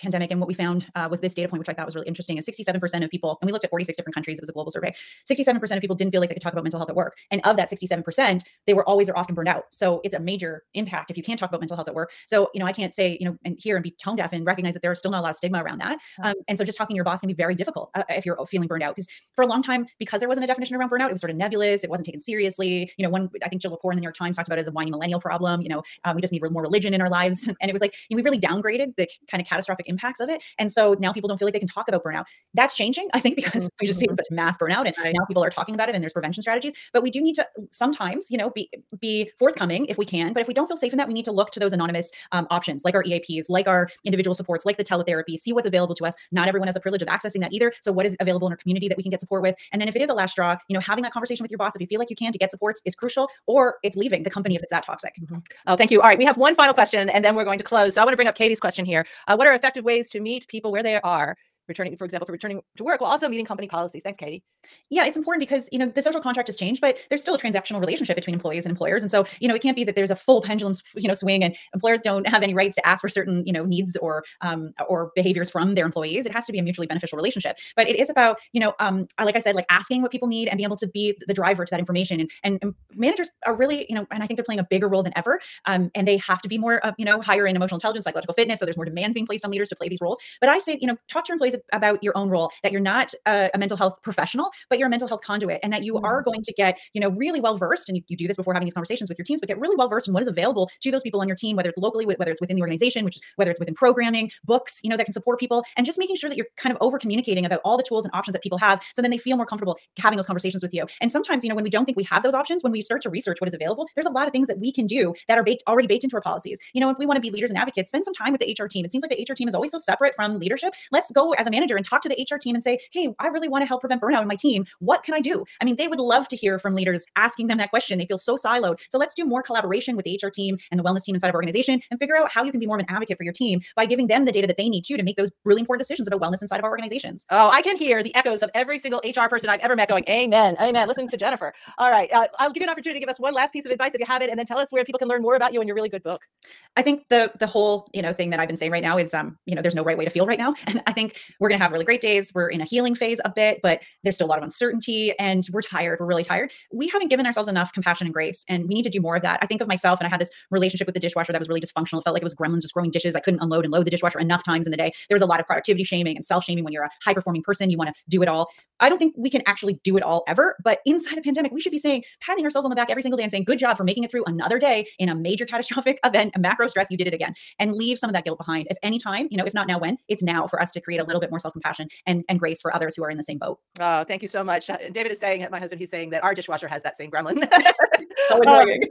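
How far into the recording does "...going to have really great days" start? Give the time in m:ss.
2:31.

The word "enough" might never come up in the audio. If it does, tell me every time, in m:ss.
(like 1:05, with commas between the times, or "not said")
2:37, 2:44.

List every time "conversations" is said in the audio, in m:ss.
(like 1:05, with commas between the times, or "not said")
0:51, 1:38, 1:50.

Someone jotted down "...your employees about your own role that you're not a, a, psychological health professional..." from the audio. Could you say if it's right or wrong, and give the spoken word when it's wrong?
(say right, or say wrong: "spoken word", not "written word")
wrong: "mental", not "psychological".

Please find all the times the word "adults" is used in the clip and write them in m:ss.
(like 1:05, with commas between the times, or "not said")
not said.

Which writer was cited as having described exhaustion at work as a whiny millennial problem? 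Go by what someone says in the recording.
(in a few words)
Jill Lepore.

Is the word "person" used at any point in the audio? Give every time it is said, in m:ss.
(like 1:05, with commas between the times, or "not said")
2:19, 2:47.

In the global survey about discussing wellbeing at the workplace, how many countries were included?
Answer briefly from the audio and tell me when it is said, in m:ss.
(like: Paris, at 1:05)
46, at 0:03.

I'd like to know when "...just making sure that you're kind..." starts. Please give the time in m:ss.
1:45.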